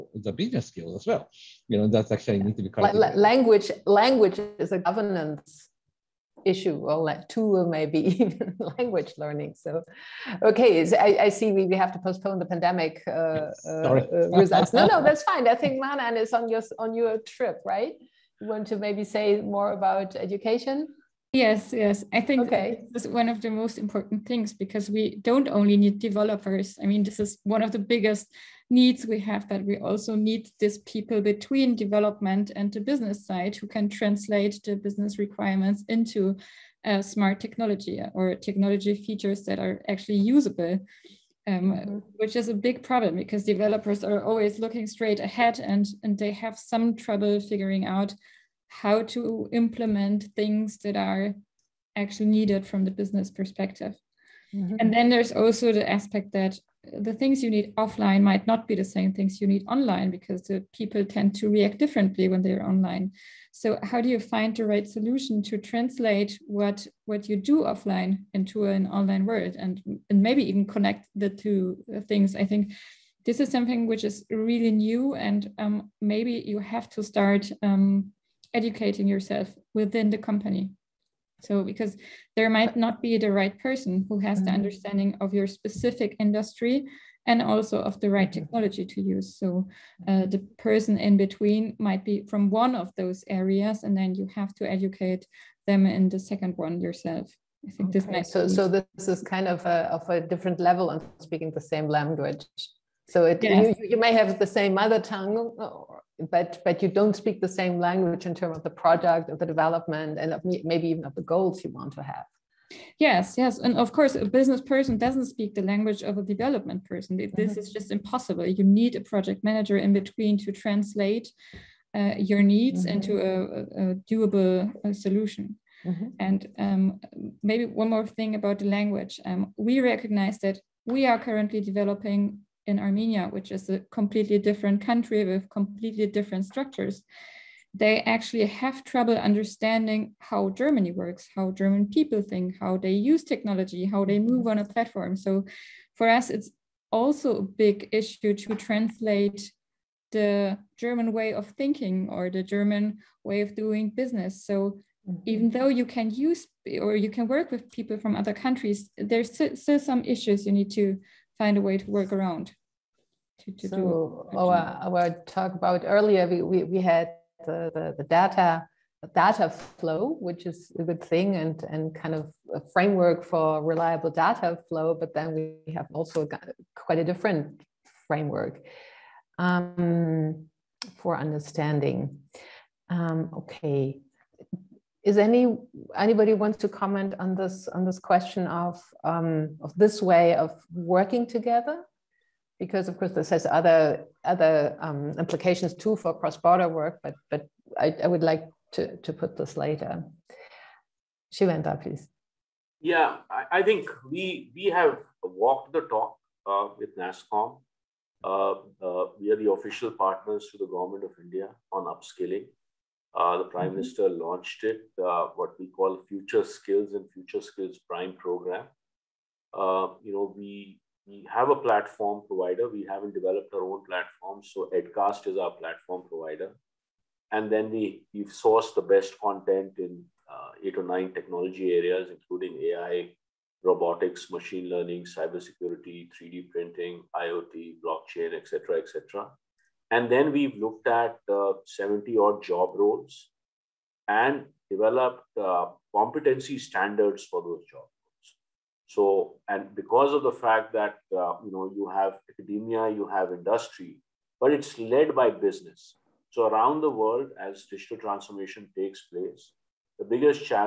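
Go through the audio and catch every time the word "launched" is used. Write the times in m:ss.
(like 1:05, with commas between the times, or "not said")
3:34.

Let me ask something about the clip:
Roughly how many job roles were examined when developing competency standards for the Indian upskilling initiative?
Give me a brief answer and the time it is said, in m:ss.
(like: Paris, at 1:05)
70, at 4:01.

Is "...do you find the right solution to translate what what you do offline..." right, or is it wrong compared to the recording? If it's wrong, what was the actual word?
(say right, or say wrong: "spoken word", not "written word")
right.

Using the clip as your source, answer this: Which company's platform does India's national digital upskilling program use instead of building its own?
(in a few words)
Edcast.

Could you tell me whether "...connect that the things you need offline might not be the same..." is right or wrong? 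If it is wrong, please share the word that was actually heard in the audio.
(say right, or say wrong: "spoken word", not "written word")
wrong: "aspect", not "connect".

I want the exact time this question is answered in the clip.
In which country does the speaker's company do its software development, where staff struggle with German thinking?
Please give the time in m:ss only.
2:12.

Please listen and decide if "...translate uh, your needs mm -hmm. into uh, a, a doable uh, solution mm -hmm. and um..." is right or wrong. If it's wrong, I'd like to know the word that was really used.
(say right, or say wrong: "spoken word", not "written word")
right.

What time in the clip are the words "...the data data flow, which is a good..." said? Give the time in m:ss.
2:47.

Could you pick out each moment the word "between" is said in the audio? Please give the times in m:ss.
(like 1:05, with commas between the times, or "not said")
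0:31, 1:31, 1:59.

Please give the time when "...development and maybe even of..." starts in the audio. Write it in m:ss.
1:49.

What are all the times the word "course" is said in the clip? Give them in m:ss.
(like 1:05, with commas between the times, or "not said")
1:53, 3:12.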